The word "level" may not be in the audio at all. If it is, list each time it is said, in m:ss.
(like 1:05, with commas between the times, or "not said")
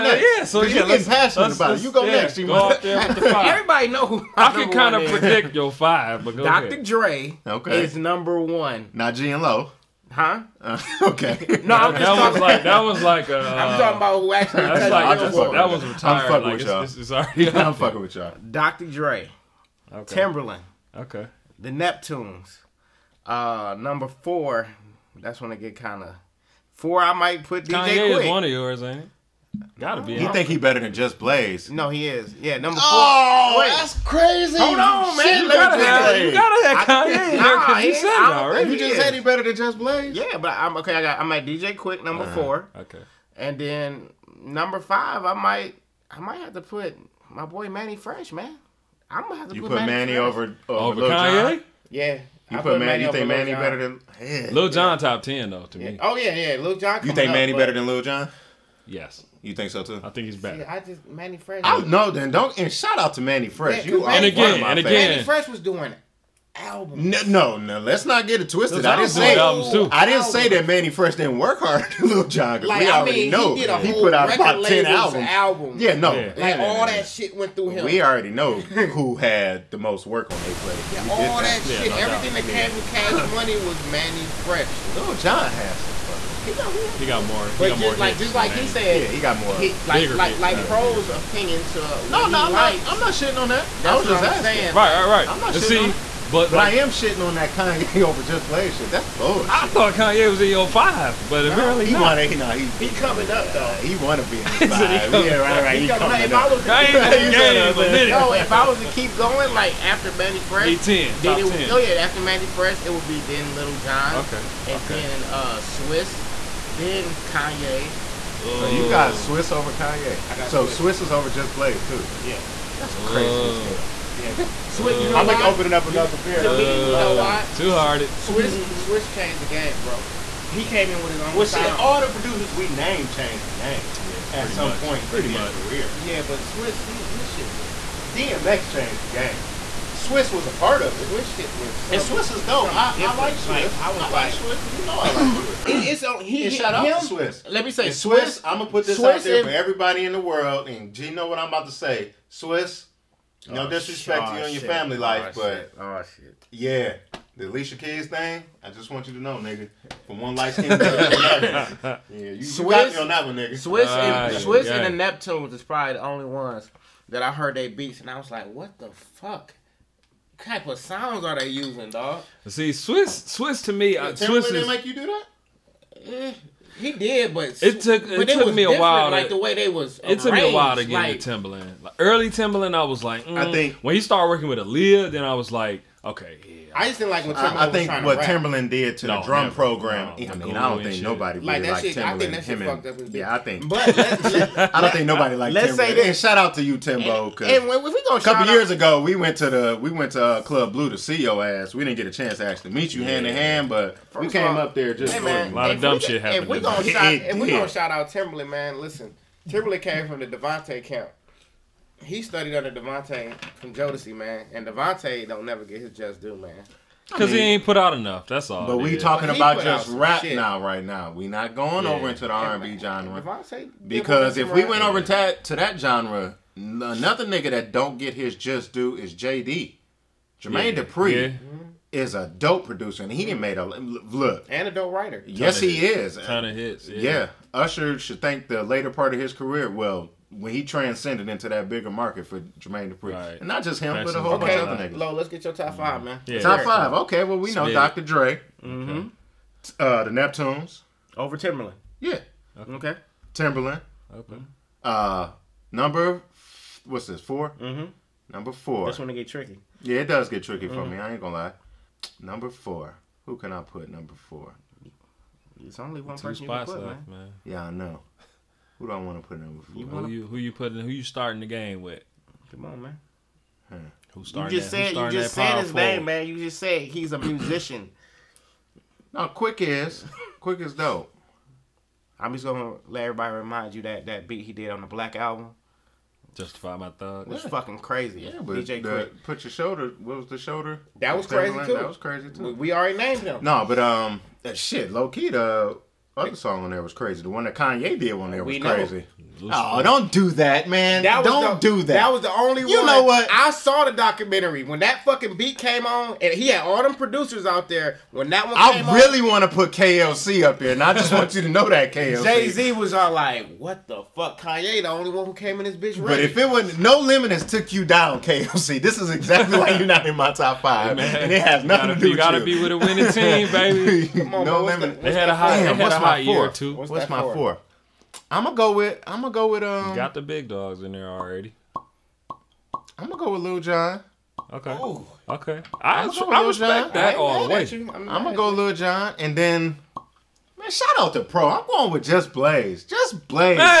not said.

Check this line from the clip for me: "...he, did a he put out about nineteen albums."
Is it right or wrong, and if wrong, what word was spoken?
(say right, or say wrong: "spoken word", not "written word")
wrong: "ten", not "nineteen".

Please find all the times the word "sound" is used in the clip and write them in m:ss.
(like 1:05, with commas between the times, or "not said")
2:11, 2:50.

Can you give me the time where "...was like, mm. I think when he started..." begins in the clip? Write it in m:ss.
3:02.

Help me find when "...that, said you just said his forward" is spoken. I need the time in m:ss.
4:34.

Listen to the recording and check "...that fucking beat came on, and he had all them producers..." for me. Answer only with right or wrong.
right.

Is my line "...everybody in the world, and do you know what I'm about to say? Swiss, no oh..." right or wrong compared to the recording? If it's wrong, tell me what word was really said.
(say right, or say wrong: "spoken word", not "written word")
right.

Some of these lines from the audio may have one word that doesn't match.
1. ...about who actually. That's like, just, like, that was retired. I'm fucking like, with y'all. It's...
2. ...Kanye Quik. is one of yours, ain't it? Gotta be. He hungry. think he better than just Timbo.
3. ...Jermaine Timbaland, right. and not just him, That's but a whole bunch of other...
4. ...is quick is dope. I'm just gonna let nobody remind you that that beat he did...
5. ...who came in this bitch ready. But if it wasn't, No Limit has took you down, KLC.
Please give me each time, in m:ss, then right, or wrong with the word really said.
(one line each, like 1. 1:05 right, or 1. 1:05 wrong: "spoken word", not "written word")
1. 0:13 right
2. 0:27 wrong: "Blaze", not "Timbo"
3. 4:02 wrong: "Dupri", not "Timbaland"
4. 4:39 wrong: "everybody", not "nobody"
5. 5:15 right.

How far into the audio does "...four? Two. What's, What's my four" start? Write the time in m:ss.
5:26.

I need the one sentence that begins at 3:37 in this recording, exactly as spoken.
Because I mean, he ain't put out enough.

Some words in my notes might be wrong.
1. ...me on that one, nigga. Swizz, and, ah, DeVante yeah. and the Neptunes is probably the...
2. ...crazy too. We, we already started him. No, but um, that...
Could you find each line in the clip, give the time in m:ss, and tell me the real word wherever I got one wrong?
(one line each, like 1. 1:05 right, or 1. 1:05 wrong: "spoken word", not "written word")
1. 2:42 wrong: "Swizz", not "DeVante"
2. 4:51 wrong: "named", not "started".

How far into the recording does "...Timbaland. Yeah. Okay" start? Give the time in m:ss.
4:11.